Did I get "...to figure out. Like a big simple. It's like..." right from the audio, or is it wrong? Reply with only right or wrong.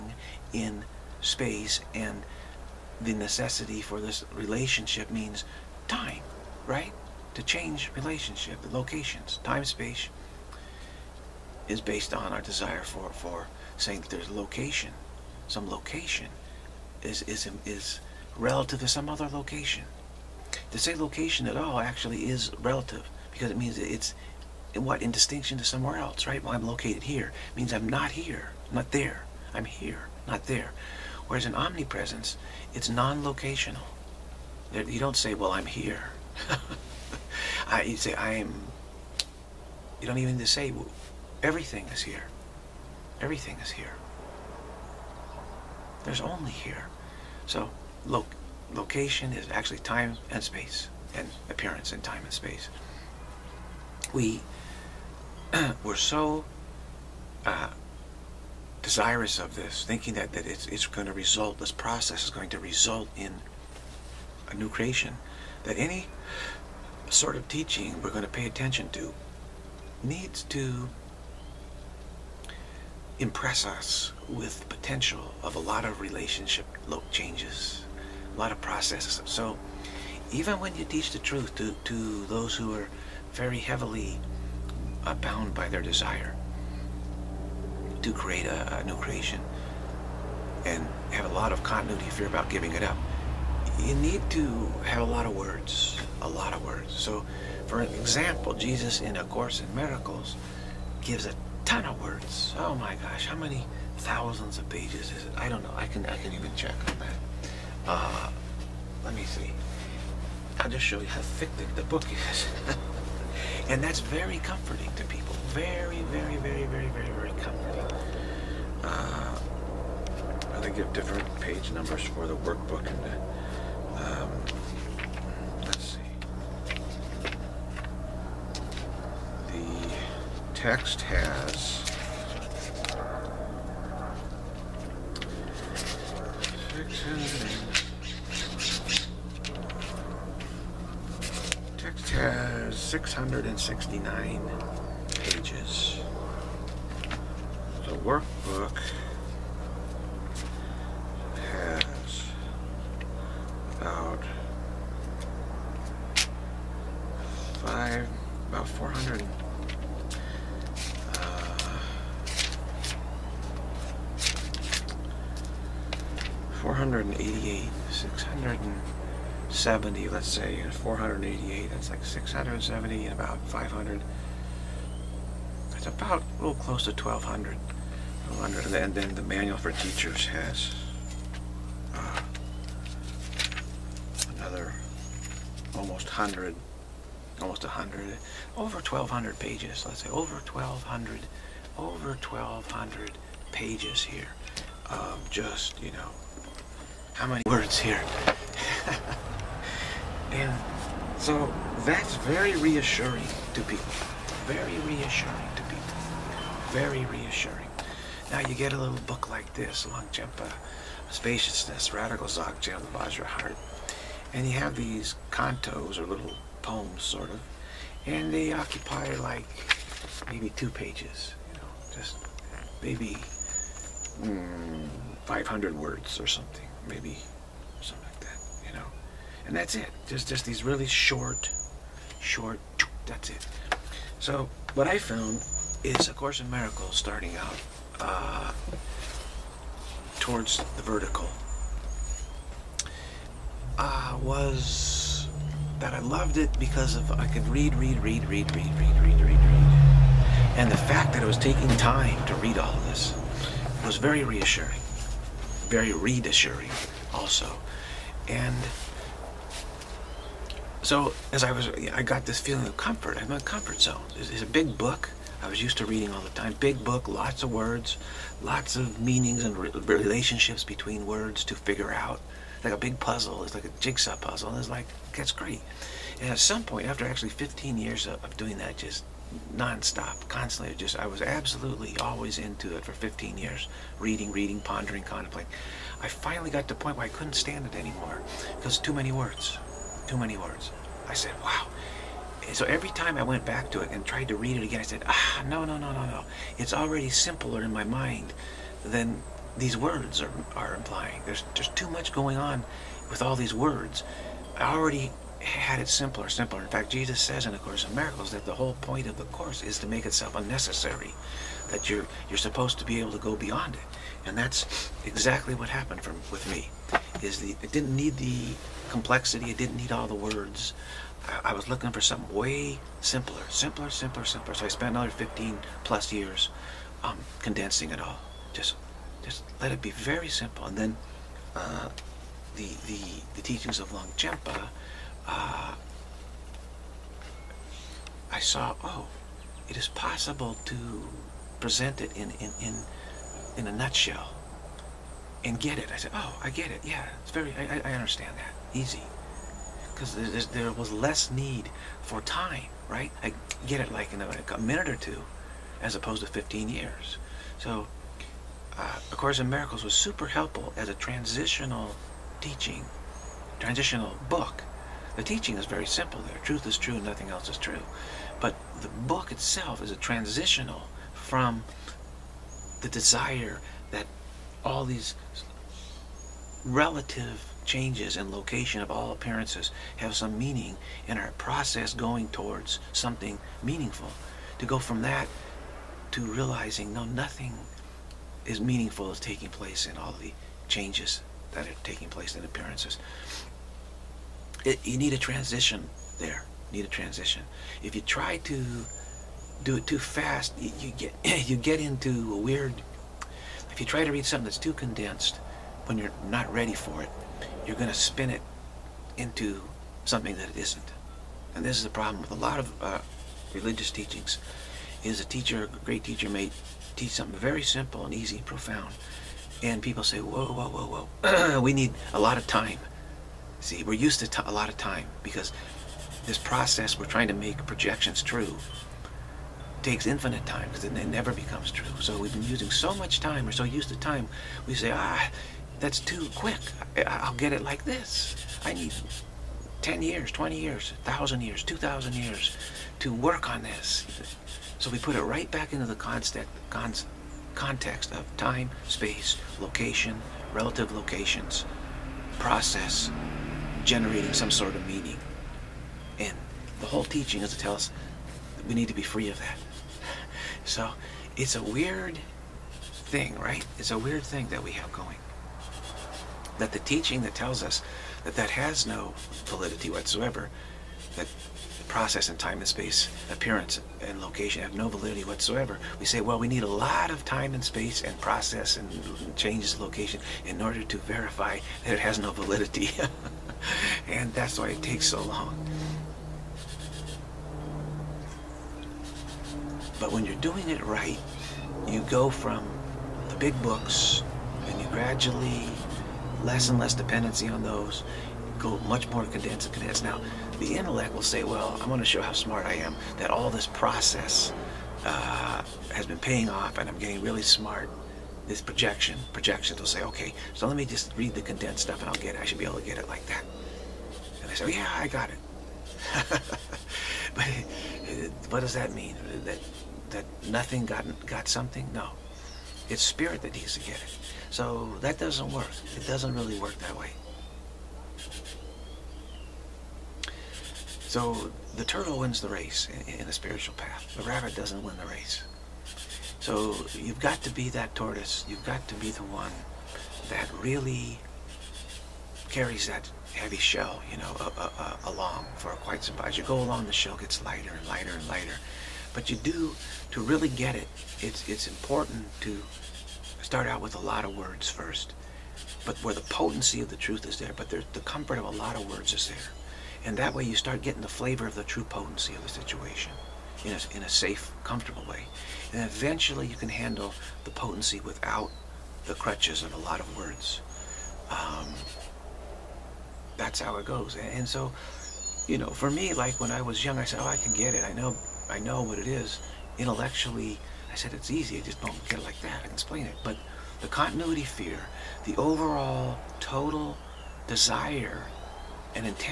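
wrong.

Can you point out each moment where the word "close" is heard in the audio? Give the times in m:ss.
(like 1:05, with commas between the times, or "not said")
2:56.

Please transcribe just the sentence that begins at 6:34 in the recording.
It, you need a transition there.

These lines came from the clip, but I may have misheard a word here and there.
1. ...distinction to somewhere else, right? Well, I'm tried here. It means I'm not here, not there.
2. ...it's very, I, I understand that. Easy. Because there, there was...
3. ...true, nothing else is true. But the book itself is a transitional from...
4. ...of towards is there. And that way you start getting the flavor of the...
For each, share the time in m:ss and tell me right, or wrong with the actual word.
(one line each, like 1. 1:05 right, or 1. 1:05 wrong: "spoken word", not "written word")
1. 0:25 wrong: "located", not "tried"
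2. 5:47 right
3. 6:06 right
4. 9:18 wrong: "words", not "towards".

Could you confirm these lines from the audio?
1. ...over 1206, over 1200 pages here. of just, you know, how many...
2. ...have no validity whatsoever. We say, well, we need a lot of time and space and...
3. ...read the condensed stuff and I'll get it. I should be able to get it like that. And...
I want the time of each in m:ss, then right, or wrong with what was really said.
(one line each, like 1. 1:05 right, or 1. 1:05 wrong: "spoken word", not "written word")
1. 3:10 wrong: "1200", not "1206"
2. 7:54 right
3. 8:31 right.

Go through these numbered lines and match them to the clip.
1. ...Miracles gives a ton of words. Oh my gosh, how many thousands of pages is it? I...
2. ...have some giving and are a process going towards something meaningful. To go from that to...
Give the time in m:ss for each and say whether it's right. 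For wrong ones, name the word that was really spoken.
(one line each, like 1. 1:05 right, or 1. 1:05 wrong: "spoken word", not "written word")
1. 1:39 right
2. 6:19 wrong: "meaning", not "giving".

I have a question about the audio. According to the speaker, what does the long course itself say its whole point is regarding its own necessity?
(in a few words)
To make itself unnecessary.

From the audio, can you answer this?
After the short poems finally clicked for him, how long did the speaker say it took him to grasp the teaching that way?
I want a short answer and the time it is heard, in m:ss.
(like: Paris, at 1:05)
A minute or two, at 5:54.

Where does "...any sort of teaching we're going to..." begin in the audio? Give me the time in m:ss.
1:05.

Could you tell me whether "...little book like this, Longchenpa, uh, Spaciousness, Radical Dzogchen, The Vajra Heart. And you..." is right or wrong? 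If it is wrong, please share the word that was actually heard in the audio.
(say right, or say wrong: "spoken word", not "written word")
right.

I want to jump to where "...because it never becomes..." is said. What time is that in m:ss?
7:10.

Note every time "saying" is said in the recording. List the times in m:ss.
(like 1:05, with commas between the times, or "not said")
0:13.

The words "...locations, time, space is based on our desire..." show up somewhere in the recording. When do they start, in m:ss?
0:08.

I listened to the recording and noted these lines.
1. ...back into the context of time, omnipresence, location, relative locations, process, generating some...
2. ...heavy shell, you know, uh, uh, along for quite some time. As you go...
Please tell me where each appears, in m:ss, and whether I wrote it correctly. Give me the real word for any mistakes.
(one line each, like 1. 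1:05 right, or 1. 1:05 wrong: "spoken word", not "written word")
1. 7:25 wrong: "space", not "omnipresence"
2. 9:03 right.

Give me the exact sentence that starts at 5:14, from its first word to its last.
And that's exactly what happened from, with me, is the, it didn't need the complexity.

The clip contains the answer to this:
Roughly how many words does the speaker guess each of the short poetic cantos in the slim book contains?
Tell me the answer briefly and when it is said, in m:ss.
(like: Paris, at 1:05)
500, at 3:45.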